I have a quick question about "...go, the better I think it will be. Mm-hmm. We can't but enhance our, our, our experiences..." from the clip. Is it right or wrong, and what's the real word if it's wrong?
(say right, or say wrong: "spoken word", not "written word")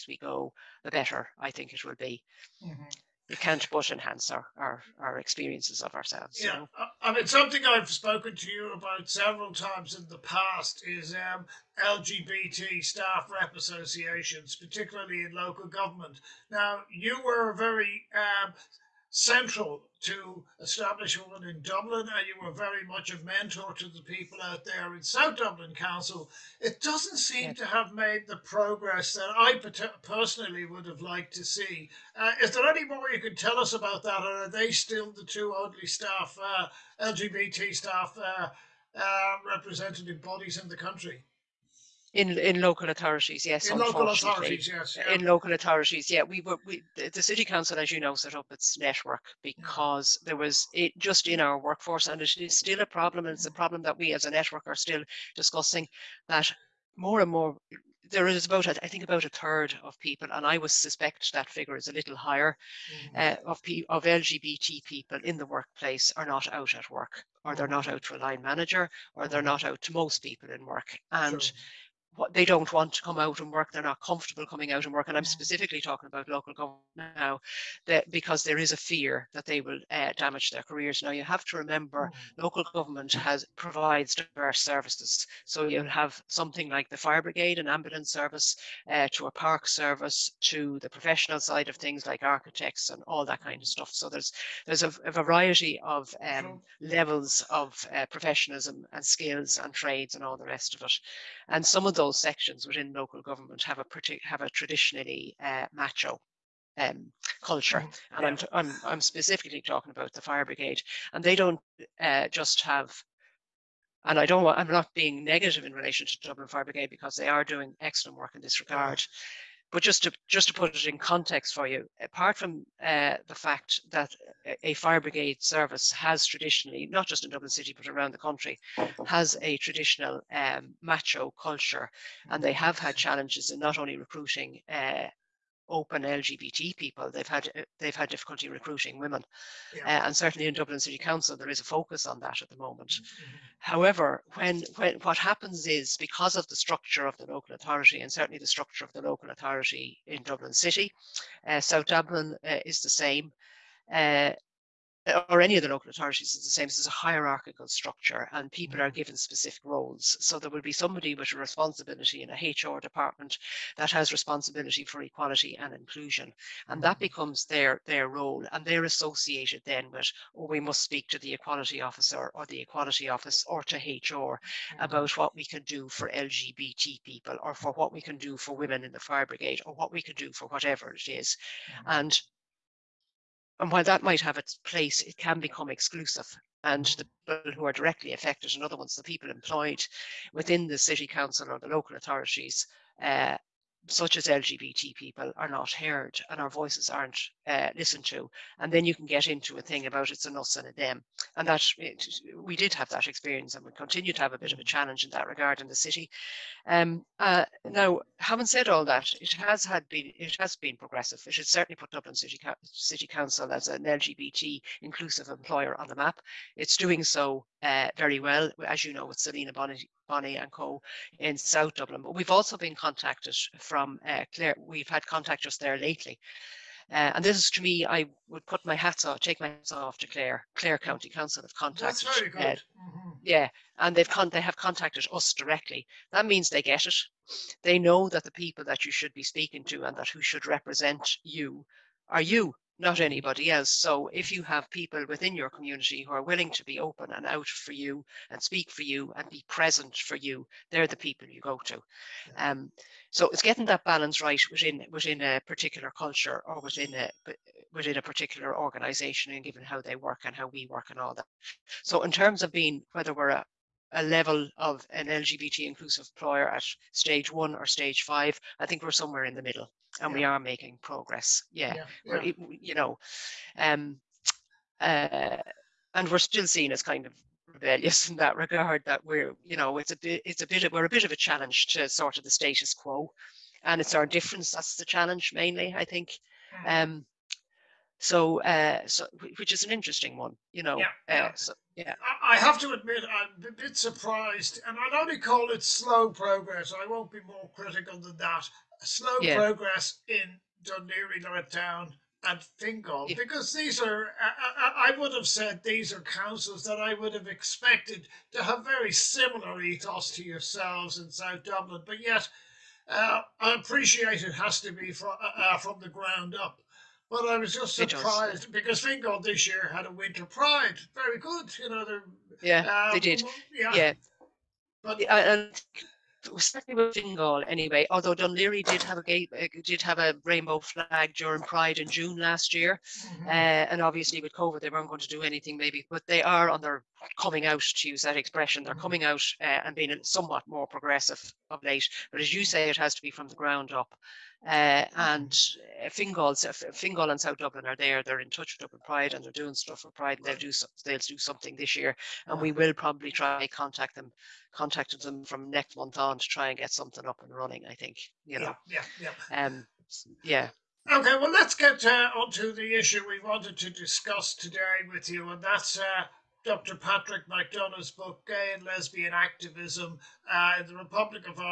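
right.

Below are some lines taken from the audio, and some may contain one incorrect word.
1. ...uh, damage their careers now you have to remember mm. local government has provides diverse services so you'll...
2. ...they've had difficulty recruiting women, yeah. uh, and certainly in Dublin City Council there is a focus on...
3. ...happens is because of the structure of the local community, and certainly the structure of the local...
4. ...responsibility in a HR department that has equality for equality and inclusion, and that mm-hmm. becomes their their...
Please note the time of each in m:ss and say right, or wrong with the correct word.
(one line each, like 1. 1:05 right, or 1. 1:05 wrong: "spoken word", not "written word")
1. 1:19 right
2. 2:17 right
3. 2:25 wrong: "authority", not "community"
4. 2:41 wrong: "responsibility", not "equality".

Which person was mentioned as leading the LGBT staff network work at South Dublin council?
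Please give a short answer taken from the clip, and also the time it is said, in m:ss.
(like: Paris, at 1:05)
Selina Bonnie, at 3:39.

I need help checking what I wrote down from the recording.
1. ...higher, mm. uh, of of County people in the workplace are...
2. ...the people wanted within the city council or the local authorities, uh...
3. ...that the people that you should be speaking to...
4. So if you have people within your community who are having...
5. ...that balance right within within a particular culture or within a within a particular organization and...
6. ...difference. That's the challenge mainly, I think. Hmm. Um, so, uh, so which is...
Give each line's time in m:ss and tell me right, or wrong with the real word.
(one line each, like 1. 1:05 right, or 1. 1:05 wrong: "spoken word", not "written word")
1. 1:02 wrong: "LGBT", not "County"
2. 3:08 wrong: "employed", not "wanted"
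3. 3:58 right
4. 4:03 wrong: "willing", not "having"
5. 4:13 right
6. 4:44 right.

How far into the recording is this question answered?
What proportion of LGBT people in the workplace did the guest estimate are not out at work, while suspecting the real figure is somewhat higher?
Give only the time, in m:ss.
0:59.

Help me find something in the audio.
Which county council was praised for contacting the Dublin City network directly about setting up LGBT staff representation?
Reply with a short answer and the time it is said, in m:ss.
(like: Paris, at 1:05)
Clare County Council, at 3:50.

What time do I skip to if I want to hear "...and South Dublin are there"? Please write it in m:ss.
5:47.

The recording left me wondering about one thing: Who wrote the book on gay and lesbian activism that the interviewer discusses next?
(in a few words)
Dr. Patrick McDonagh.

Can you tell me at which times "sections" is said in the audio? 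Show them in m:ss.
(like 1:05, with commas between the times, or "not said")
1:42.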